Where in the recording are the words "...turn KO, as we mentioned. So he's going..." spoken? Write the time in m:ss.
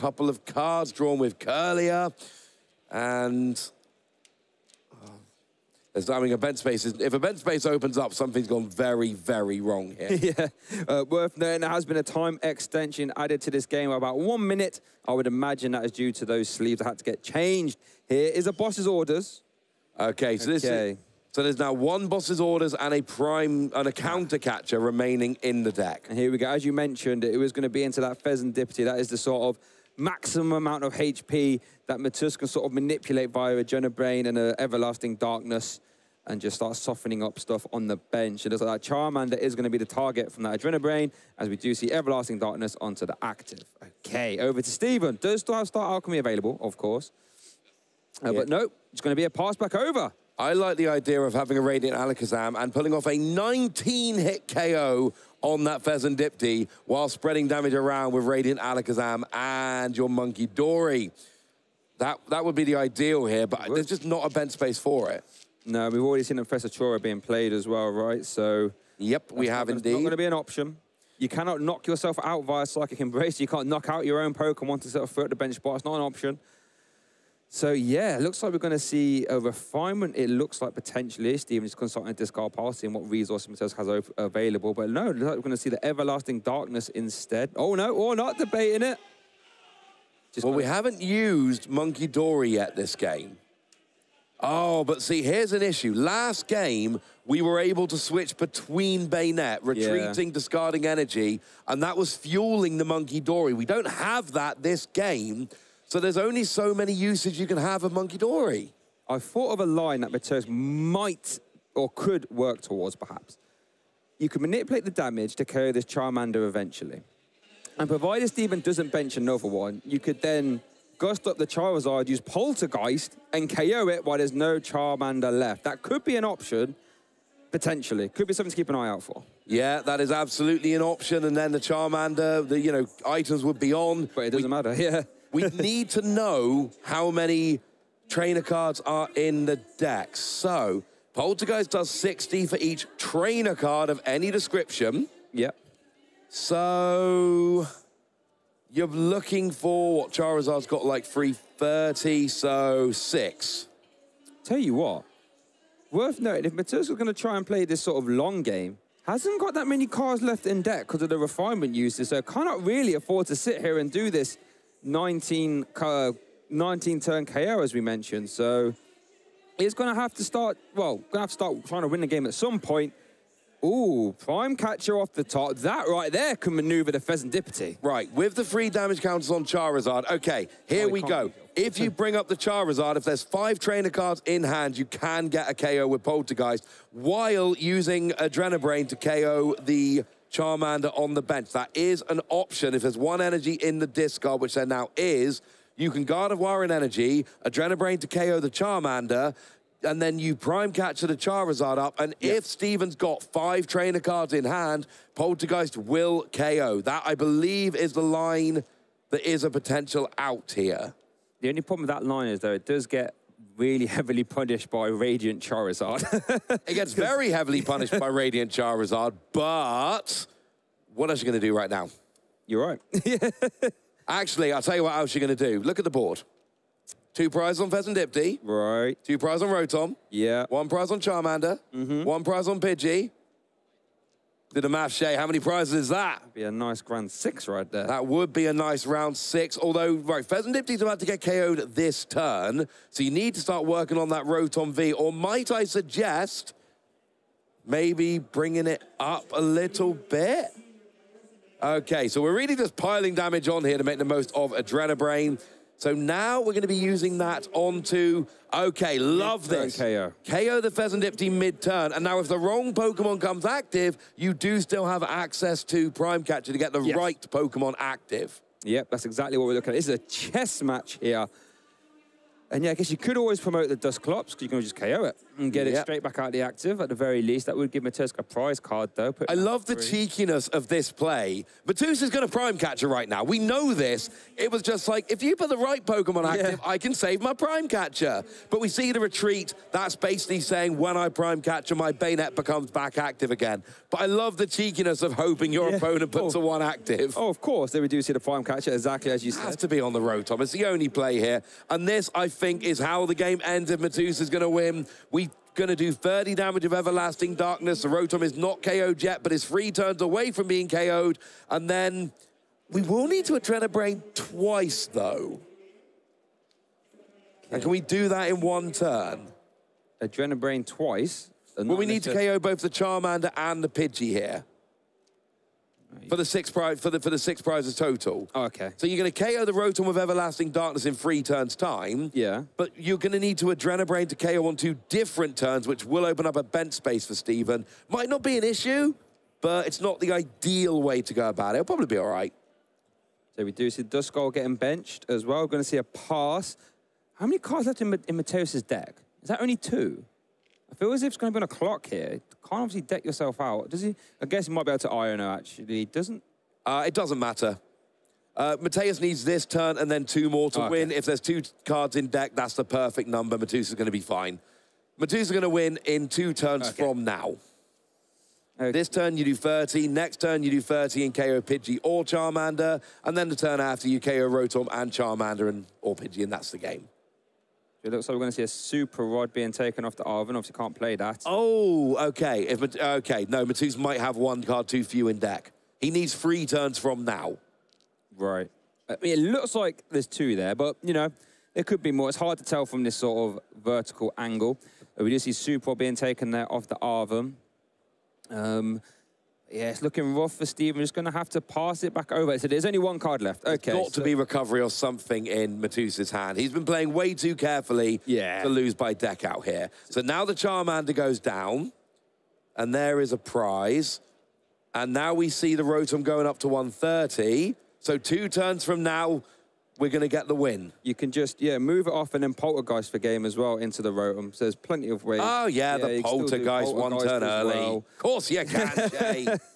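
2:46.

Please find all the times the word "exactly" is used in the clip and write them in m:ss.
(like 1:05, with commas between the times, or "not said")
4:29, 4:58.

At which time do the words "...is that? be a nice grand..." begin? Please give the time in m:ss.
3:55.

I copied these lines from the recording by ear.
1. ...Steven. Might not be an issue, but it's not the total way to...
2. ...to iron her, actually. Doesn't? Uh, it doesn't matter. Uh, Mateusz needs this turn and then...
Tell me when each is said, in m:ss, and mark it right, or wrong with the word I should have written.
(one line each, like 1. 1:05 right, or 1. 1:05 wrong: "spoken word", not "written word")
1. 5:37 wrong: "ideal", not "total"
2. 5:54 right.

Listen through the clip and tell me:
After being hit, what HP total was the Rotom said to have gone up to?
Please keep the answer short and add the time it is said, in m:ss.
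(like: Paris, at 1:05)
130, at 6:56.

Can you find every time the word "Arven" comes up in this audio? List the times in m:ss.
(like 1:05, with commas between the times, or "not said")
6:20, 6:36.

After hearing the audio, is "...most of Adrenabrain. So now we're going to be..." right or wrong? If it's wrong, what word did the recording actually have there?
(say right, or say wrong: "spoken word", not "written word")
right.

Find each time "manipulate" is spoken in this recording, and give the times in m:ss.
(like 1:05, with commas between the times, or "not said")
0:32, 1:54.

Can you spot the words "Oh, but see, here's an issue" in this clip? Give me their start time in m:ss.
1:34.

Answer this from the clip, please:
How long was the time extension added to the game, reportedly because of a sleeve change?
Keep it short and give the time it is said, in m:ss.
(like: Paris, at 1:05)
About one minute, at 0:13.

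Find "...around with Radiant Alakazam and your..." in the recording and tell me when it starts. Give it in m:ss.
0:57.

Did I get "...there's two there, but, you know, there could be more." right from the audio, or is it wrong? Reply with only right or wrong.
right.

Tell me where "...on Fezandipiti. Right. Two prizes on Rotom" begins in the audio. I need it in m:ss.
3:47.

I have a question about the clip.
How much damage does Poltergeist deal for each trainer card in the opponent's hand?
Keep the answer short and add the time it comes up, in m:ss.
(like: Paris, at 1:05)
60, at 2:21.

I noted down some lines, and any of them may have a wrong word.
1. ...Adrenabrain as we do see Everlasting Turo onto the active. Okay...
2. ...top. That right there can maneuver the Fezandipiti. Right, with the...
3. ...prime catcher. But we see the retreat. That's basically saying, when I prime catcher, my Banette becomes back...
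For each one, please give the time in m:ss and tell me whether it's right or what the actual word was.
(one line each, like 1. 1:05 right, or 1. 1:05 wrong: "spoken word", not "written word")
1. 0:40 wrong: "Darkness", not "Turo"
2. 2:55 right
3. 4:47 right.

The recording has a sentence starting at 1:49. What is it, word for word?
I thought of a line that Mateusz might or could work towards, perhaps.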